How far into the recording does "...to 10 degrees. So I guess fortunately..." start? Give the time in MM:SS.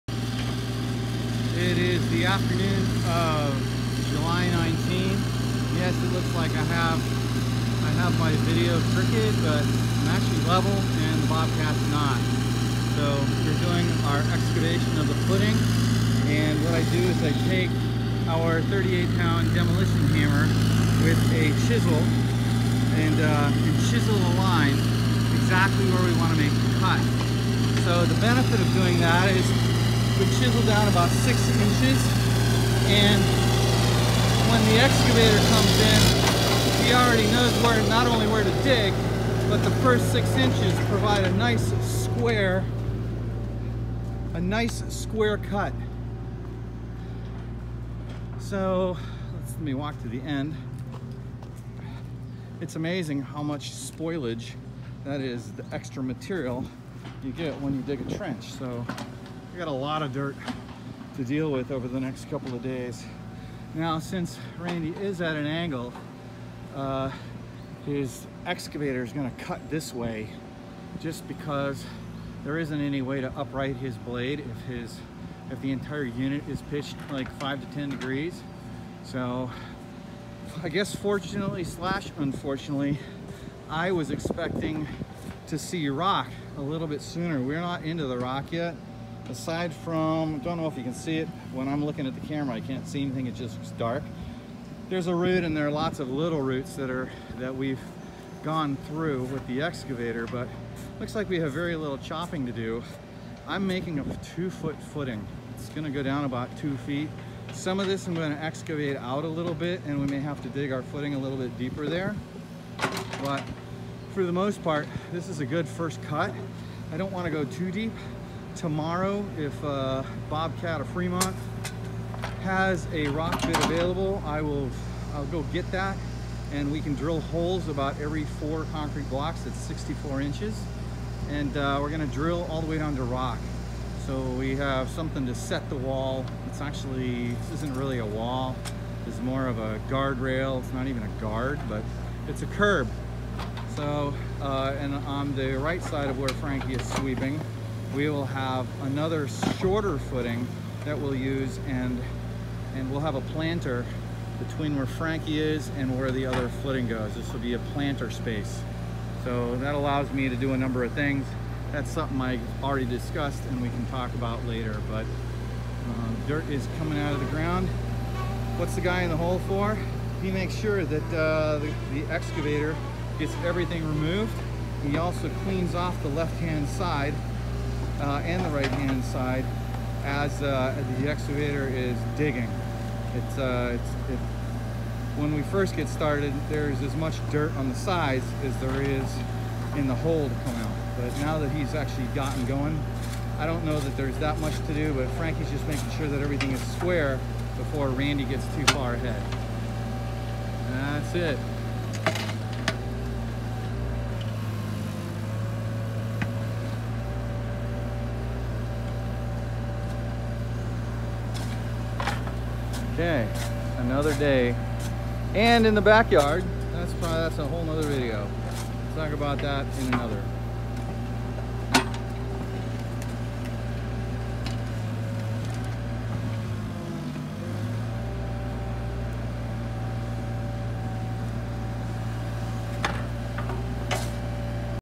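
01:17.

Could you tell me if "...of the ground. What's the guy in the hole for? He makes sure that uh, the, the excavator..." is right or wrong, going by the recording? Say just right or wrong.
right.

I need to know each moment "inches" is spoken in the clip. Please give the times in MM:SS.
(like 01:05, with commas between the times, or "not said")
00:31, 00:40, 02:10.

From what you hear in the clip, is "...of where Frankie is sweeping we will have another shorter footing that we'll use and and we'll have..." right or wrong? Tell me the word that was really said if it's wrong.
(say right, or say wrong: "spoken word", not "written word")
right.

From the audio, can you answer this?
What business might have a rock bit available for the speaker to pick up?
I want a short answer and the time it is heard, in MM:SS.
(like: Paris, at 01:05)
Bobcat of Fremont, at 02:00.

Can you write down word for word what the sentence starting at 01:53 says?
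But for the most part, this is a good first cut.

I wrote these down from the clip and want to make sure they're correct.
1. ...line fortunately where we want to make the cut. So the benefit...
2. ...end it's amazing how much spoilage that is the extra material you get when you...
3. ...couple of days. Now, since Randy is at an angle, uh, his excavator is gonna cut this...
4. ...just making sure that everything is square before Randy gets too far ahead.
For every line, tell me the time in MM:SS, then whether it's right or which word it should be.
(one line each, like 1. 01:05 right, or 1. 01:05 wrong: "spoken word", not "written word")
1. 00:24 wrong: "exactly", not "fortunately"
2. 00:50 right
3. 01:02 right
4. 03:15 right.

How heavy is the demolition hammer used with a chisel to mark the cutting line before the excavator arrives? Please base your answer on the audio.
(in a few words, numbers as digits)
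38 pounds.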